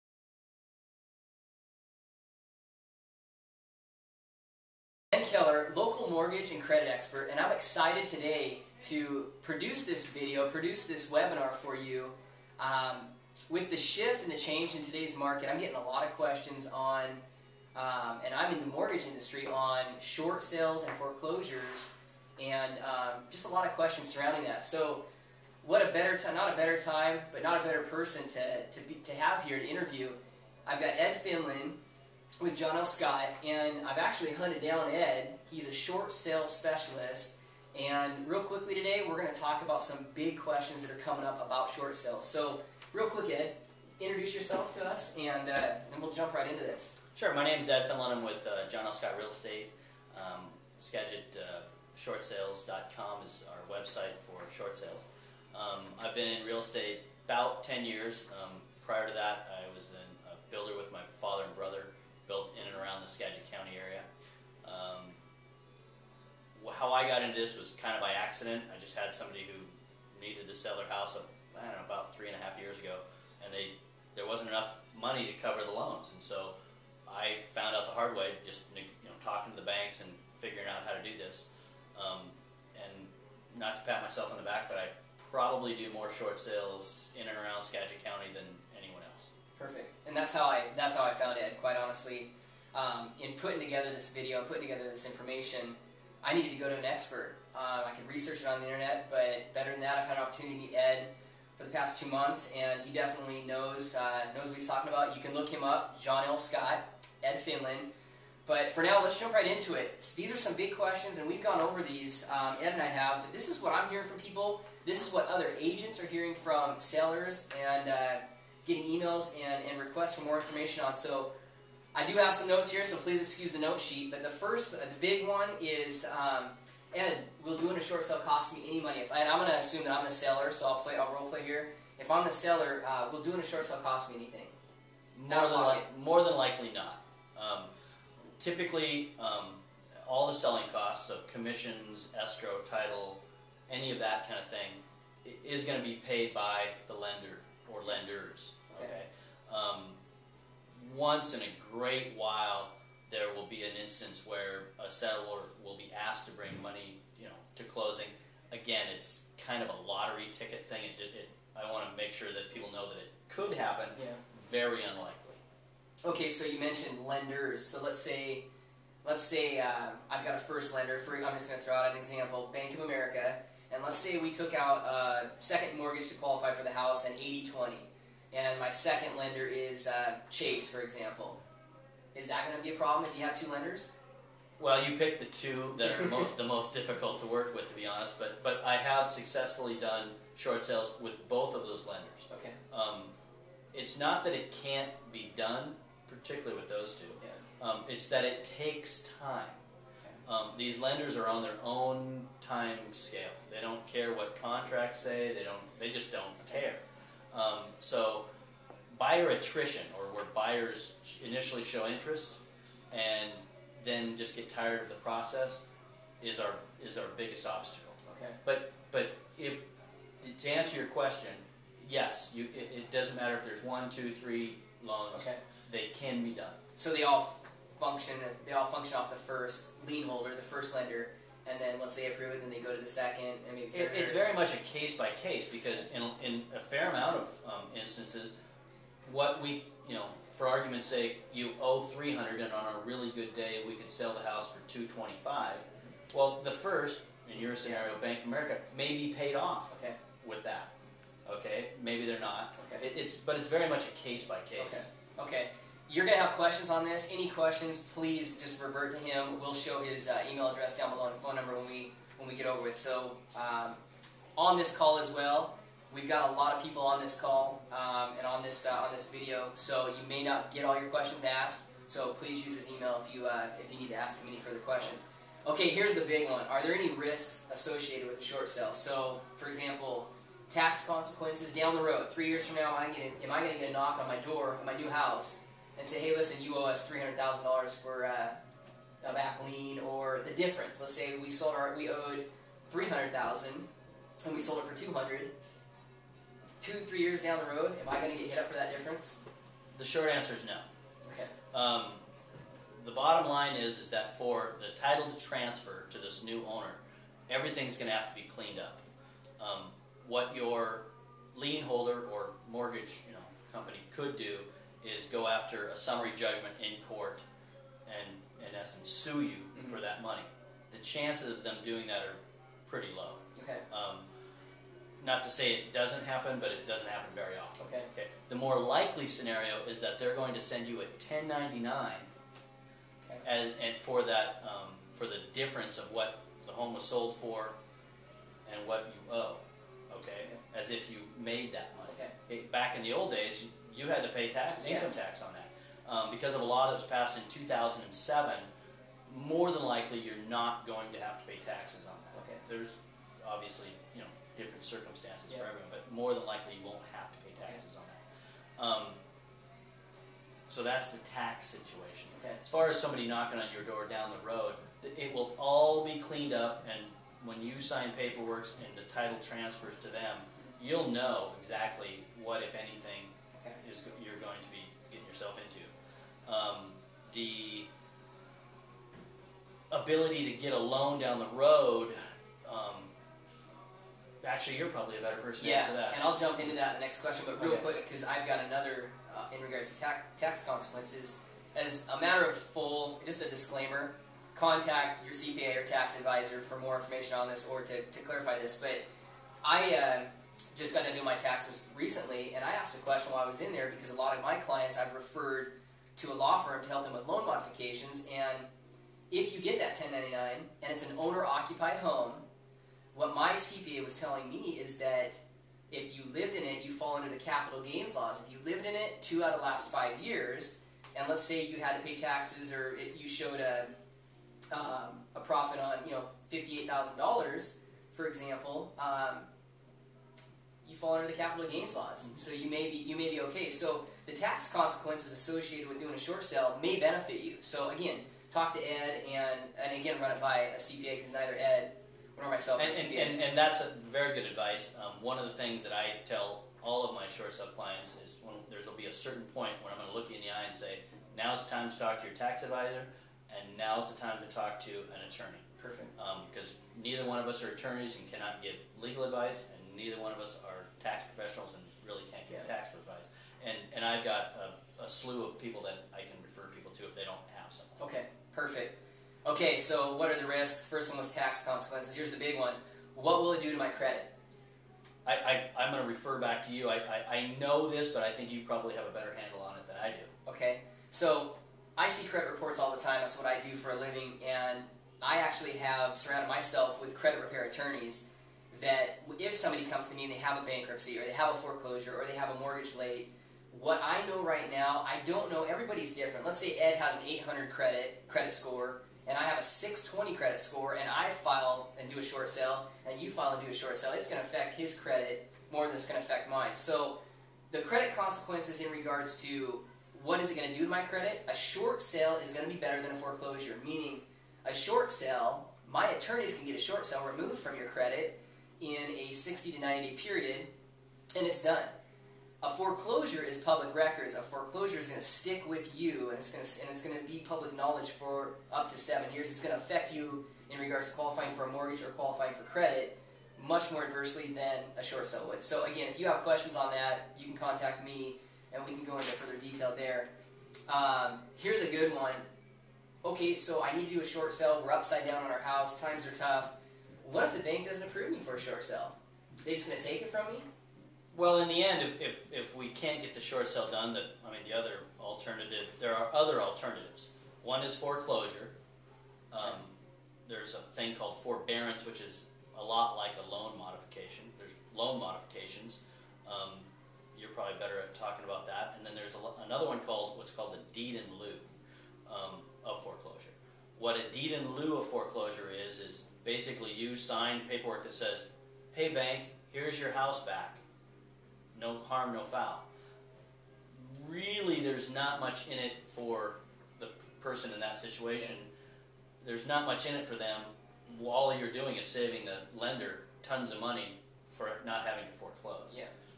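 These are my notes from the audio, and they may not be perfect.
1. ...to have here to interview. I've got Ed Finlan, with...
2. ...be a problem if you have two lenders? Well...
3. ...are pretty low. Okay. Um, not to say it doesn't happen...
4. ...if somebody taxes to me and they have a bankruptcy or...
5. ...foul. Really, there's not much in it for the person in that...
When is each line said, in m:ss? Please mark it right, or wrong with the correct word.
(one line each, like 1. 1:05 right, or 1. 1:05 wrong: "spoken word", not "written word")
1. 0:29 right
2. 3:02 right
3. 5:21 right
4. 8:09 wrong: "comes", not "taxes"
5. 9:42 right.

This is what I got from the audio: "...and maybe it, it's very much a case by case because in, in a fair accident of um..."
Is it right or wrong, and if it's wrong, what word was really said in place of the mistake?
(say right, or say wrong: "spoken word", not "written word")
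wrong: "amount", not "accident".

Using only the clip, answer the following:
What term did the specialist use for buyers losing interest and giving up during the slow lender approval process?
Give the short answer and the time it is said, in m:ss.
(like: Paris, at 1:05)
buyer attrition, at 3:28.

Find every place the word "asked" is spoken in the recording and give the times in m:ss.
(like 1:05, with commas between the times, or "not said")
2:36, 4:31, 6:42.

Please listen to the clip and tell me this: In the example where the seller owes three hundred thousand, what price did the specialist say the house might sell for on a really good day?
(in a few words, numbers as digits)
$225,000.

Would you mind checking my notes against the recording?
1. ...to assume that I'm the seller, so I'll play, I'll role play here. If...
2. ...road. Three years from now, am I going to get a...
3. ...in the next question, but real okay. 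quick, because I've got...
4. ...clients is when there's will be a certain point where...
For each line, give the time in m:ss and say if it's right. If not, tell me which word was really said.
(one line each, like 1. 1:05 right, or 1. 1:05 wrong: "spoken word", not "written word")
1. 2:09 right
2. 4:41 right
3. 6:26 right
4. 7:27 right.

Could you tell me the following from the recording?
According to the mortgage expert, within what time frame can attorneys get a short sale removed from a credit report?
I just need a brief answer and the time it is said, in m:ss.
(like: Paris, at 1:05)
60 to 90 days, at 8:39.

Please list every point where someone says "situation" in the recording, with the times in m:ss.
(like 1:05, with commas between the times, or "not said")
6:01, 9:47.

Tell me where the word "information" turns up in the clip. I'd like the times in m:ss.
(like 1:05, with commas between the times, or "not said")
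1:35, 2:00, 6:36.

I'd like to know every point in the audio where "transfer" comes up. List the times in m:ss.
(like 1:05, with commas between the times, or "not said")
5:05, 6:09.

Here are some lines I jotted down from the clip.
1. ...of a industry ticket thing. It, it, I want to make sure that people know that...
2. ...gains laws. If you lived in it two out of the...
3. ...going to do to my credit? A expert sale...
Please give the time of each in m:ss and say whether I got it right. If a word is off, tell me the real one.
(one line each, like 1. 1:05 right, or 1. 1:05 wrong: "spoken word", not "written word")
1. 2:39 wrong: "lottery", not "industry"
2. 6:57 right
3. 8:30 wrong: "short", not "expert".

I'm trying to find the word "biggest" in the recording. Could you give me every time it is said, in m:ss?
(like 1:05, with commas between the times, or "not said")
3:37.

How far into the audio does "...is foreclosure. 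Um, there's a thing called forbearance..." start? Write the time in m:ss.
9:17.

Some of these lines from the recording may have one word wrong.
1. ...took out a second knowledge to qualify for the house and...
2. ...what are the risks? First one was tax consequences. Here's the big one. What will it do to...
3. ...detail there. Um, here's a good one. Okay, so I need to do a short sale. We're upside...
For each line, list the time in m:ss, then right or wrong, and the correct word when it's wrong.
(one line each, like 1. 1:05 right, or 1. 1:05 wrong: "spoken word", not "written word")
1. 2:54 wrong: "mortgage", not "knowledge"
2. 7:49 right
3. 8:59 right.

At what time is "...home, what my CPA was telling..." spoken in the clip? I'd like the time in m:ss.
6:51.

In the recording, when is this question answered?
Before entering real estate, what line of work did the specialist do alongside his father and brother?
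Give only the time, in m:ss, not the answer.
1:00.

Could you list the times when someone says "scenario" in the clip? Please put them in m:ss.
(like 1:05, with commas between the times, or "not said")
4:07, 5:29.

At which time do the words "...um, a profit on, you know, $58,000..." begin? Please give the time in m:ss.
7:04.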